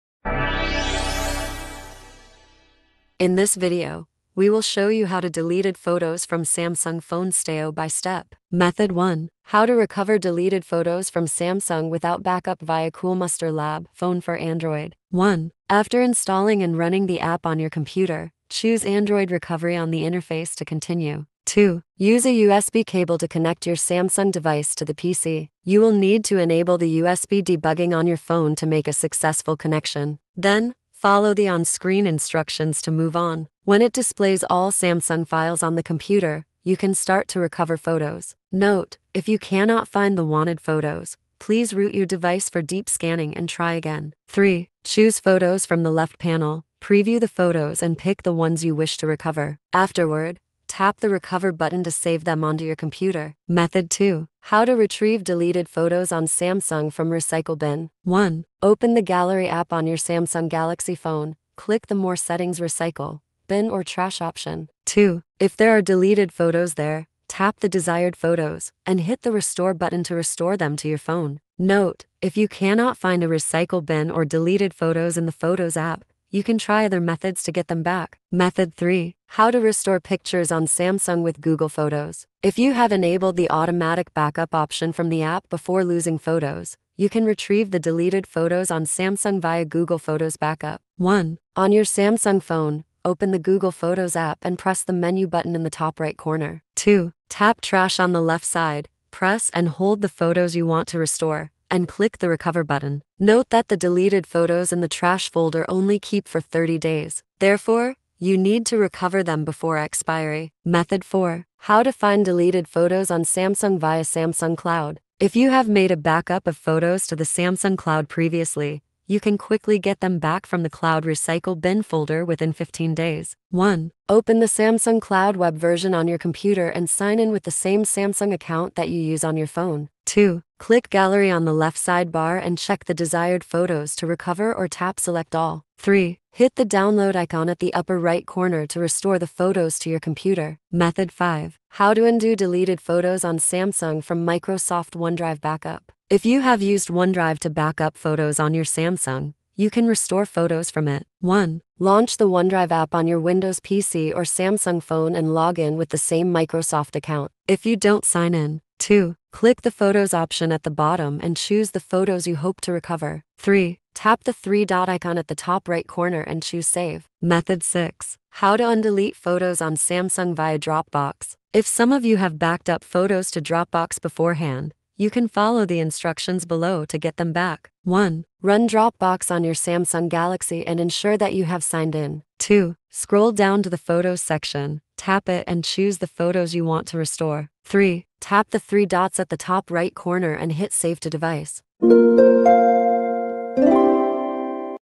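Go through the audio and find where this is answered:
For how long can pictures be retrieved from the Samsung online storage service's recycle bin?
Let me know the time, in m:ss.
2:02.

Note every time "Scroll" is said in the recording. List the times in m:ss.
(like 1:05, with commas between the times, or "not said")
3:02.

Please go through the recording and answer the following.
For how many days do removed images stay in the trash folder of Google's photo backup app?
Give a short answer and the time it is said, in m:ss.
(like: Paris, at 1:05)
30 days, at 1:46.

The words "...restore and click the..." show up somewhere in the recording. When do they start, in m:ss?
1:40.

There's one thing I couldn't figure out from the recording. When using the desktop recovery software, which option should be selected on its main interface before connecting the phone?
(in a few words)
Android Recovery.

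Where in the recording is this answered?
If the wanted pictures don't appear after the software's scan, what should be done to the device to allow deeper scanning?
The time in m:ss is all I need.
0:41.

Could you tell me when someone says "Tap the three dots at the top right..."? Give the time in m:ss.
3:08.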